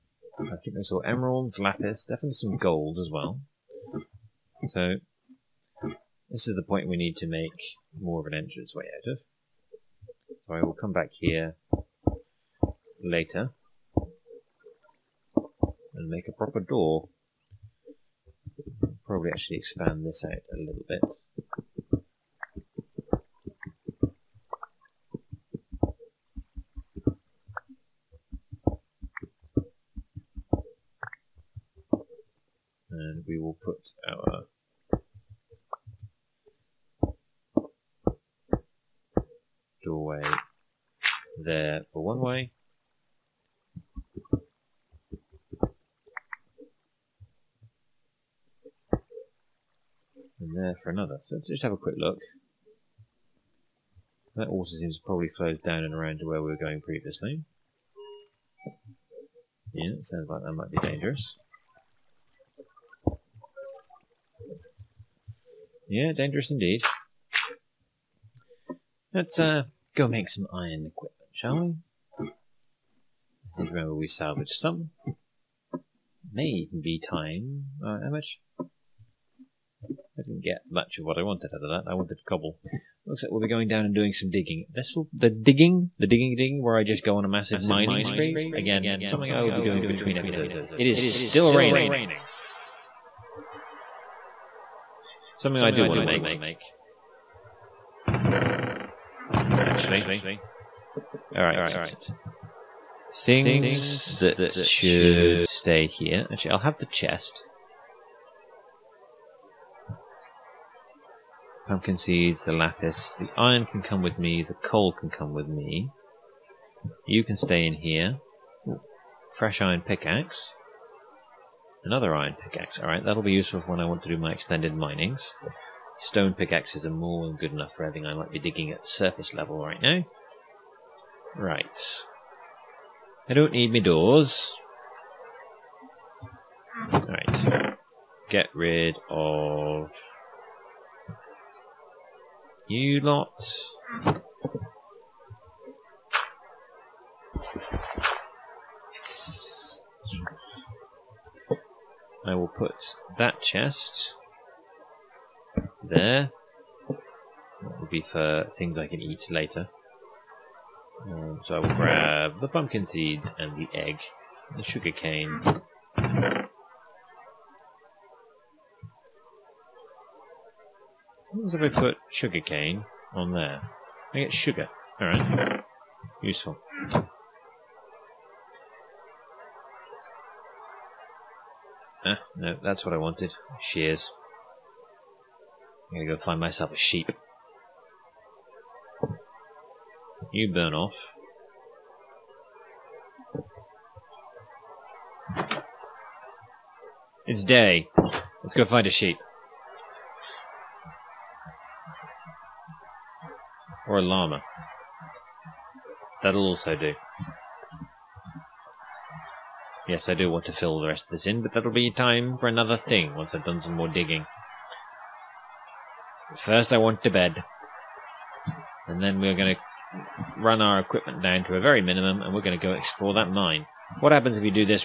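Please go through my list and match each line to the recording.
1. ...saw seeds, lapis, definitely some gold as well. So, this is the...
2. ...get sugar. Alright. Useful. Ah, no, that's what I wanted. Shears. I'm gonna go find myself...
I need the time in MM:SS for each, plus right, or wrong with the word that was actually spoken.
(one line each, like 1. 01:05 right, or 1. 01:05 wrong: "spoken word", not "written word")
1. 00:00 wrong: "emeralds", not "seeds"
2. 02:54 right.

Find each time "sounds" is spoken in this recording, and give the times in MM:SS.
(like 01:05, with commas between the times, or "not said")
01:00.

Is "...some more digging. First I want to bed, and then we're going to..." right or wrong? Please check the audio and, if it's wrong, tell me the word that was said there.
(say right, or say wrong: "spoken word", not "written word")
right.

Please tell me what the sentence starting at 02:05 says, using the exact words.
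Stone pickaxes are more than good enough for everything I might be digging at surface level right now.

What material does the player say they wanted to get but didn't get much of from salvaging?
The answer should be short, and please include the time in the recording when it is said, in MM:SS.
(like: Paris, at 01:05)
Cobble, at 01:22.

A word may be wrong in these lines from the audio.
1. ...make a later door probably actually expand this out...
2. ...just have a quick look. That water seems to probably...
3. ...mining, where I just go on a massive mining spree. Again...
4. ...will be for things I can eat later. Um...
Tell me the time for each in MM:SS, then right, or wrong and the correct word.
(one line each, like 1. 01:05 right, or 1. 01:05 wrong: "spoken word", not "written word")
1. 00:16 wrong: "proper", not "later"
2. 00:51 right
3. 01:26 wrong: "digging", not "mining"
4. 02:37 right.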